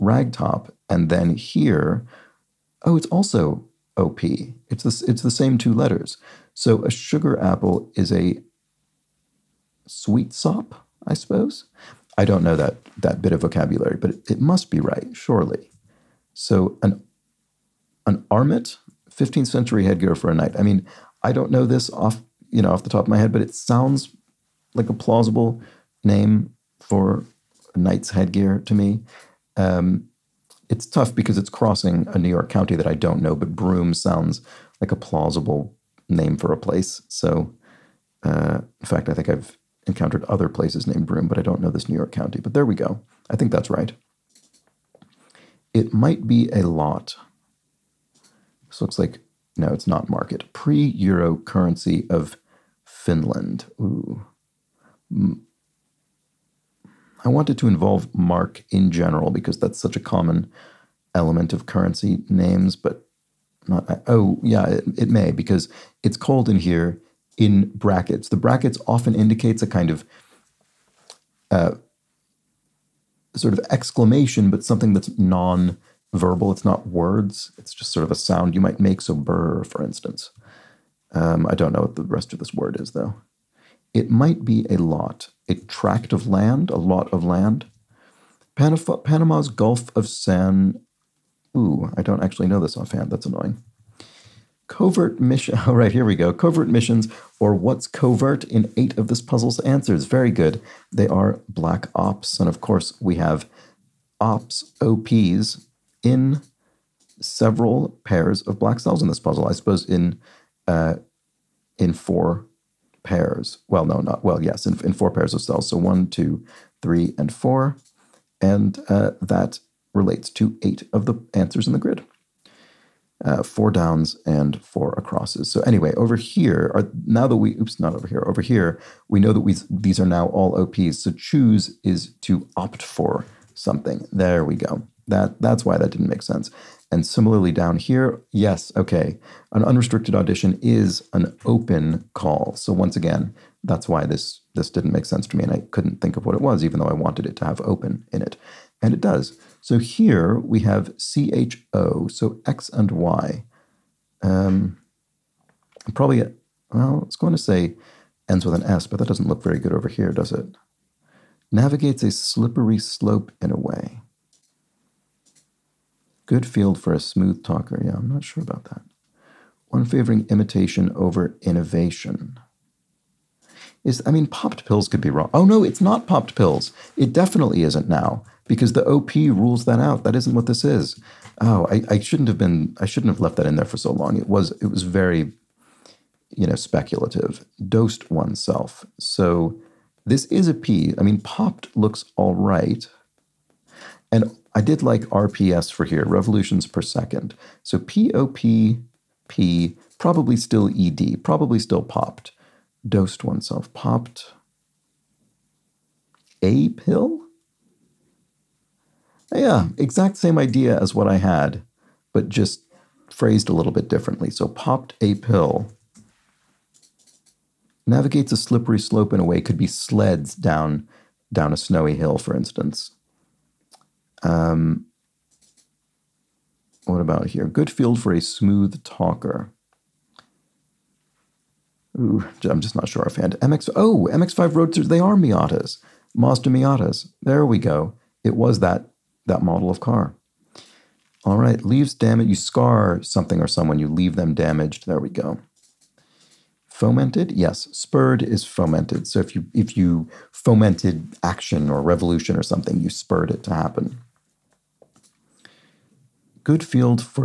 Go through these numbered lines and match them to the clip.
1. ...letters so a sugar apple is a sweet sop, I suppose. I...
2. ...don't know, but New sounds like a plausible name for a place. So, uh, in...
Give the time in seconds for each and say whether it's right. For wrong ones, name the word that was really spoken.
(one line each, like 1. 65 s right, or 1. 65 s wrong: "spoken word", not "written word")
1. 5 s right
2. 32 s wrong: "Broome", not "New".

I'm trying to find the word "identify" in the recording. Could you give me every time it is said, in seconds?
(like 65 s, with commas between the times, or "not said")
not said.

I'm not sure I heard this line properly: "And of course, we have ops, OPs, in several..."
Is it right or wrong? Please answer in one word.
right.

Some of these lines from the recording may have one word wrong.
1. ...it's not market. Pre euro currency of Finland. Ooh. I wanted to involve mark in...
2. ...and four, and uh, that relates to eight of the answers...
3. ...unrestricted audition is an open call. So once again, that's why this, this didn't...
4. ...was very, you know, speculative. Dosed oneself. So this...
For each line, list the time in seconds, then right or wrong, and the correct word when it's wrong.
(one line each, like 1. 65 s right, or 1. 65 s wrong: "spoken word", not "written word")
1. 49 s right
2. 117 s right
3. 139 s right
4. 184 s right.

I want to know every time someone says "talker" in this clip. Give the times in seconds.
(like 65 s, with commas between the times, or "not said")
167 s, 228 s.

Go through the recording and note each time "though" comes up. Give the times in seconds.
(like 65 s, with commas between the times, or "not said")
82 s, 146 s.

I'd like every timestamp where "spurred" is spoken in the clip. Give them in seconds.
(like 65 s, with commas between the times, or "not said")
247 s, 252 s.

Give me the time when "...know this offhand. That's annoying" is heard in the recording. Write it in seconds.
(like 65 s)
92 s.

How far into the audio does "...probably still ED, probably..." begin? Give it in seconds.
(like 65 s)
199 s.